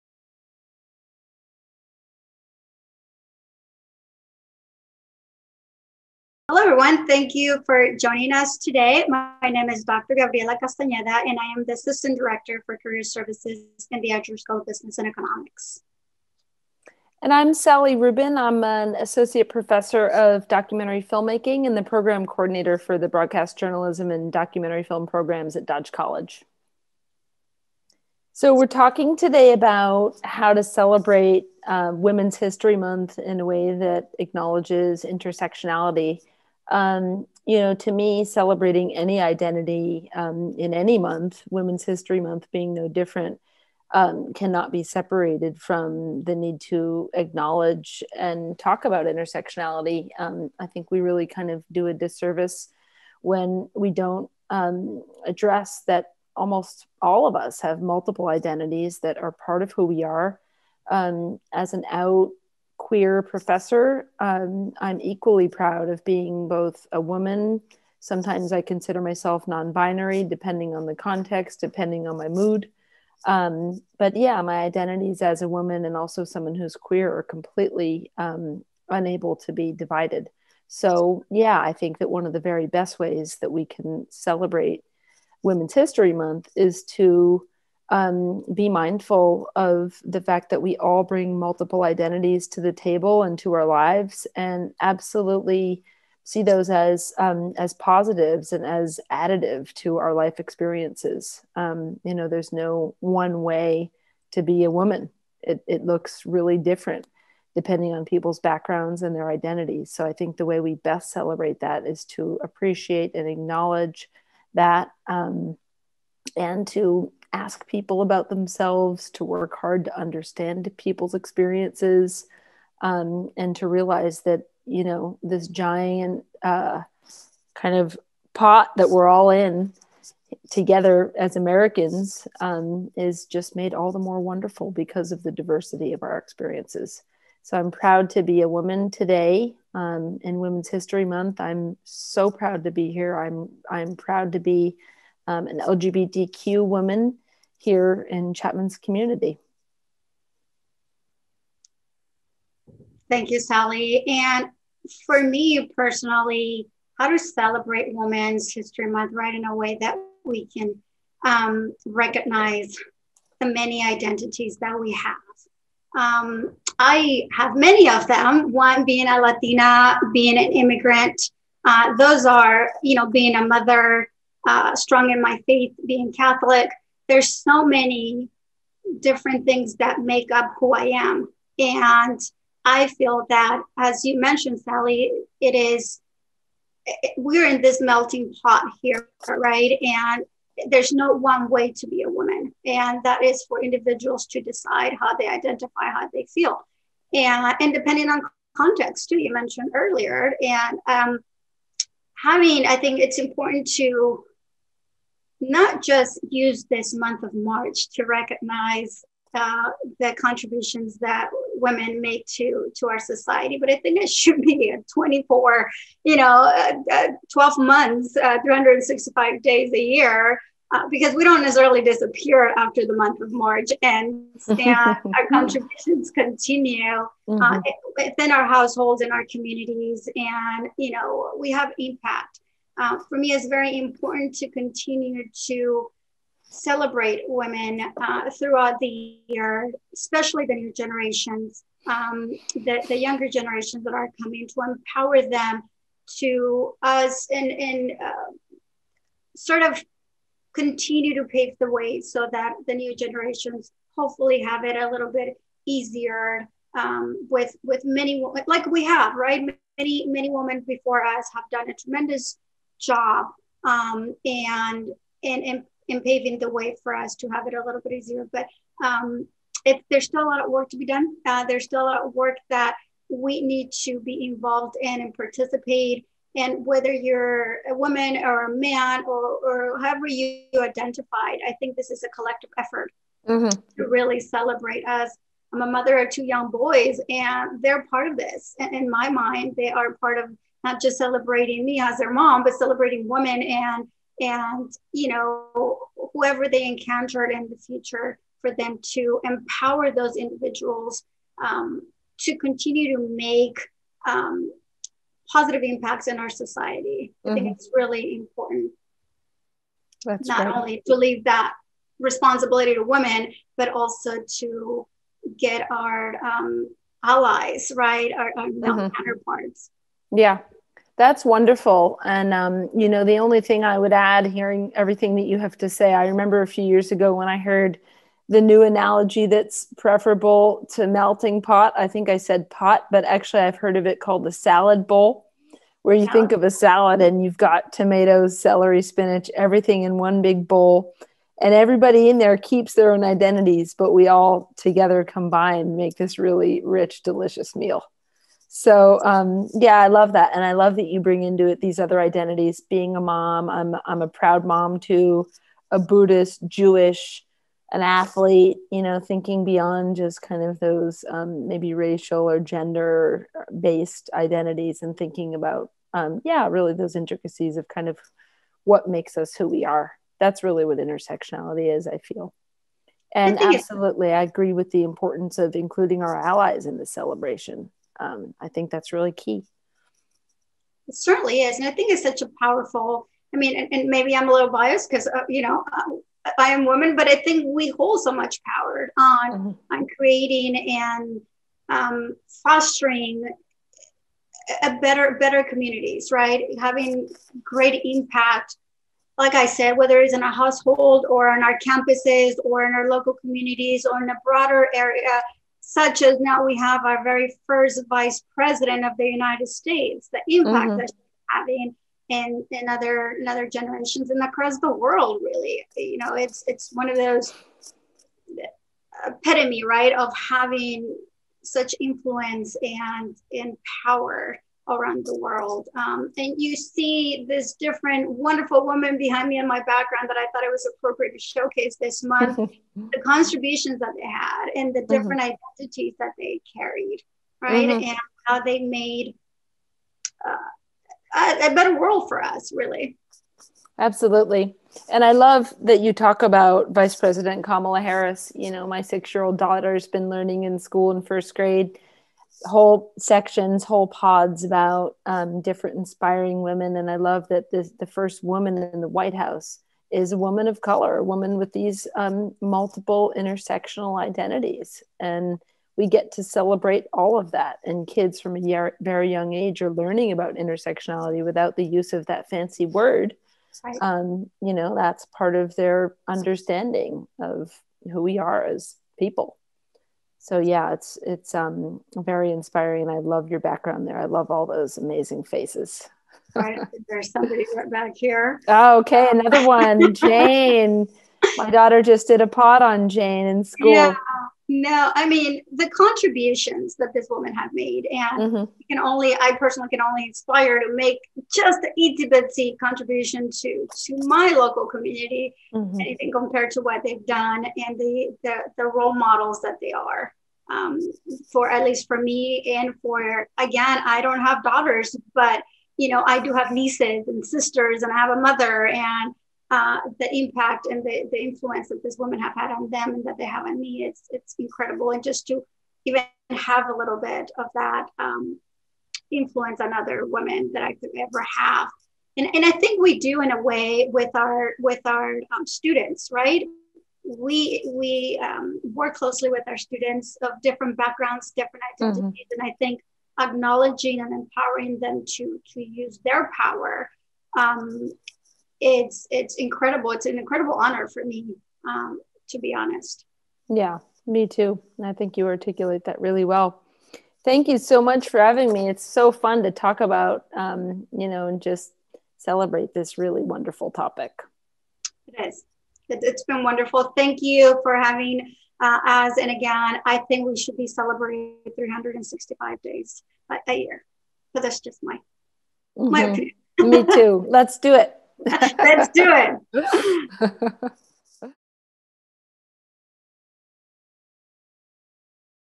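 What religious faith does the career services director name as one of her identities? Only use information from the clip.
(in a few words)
Catholic.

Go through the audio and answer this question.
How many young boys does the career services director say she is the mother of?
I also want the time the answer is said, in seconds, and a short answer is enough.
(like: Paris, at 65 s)
2, at 286 s.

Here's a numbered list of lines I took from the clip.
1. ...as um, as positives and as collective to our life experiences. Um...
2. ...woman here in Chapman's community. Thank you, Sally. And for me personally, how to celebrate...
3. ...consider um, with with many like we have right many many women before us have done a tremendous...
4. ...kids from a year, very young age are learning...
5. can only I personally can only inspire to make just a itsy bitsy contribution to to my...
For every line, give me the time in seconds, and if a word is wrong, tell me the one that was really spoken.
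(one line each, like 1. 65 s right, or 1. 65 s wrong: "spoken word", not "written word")
1. 96 s wrong: "additive", not "collective"
2. 146 s right
3. 255 s wrong: "easier", not "consider"
4. 467 s right
5. 498 s right.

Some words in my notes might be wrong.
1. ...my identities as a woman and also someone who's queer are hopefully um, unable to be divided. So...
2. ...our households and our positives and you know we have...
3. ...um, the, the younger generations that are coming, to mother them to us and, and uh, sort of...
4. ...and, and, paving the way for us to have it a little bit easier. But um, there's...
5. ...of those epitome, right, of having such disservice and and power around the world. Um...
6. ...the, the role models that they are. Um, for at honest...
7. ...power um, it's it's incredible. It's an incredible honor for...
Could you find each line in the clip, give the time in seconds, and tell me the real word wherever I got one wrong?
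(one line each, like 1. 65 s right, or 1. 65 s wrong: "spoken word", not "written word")
1. 74 s wrong: "completely", not "hopefully"
2. 228 s wrong: "communities", not "positives"
3. 241 s wrong: "empower", not "mother"
4. 265 s right
5. 416 s wrong: "influence", not "disservice"
6. 508 s wrong: "least", not "honest"
7. 546 s right.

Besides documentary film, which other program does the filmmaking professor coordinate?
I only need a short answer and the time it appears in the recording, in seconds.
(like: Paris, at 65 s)
Broadcast Journalism, at 23 s.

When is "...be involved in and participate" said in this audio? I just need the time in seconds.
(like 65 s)
273 s.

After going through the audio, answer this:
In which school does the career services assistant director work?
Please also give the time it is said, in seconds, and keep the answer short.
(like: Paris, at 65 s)
Edger School of Business and Economics, at 14 s.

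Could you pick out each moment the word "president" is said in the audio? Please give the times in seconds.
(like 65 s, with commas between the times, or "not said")
408 s, 446 s.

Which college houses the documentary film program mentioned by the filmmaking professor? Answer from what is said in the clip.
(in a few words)
Dodge College.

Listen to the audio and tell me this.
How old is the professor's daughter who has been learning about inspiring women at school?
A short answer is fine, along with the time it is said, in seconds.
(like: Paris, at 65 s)
6, at 448 s.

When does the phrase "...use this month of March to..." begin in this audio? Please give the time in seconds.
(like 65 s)
206 s.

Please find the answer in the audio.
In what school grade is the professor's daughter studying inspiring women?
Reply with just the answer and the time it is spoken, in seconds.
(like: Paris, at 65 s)
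first grade, at 451 s.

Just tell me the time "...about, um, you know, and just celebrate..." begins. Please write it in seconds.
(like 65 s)
559 s.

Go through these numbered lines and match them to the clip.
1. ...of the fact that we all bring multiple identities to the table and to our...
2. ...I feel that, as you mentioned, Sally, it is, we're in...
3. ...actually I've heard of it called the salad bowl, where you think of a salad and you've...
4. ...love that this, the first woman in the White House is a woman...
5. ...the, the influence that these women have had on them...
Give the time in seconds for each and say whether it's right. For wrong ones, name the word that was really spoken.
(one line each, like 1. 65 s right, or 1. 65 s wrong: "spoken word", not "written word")
1. 89 s right
2. 182 s right
3. 333 s right
4. 456 s right
5. 520 s right.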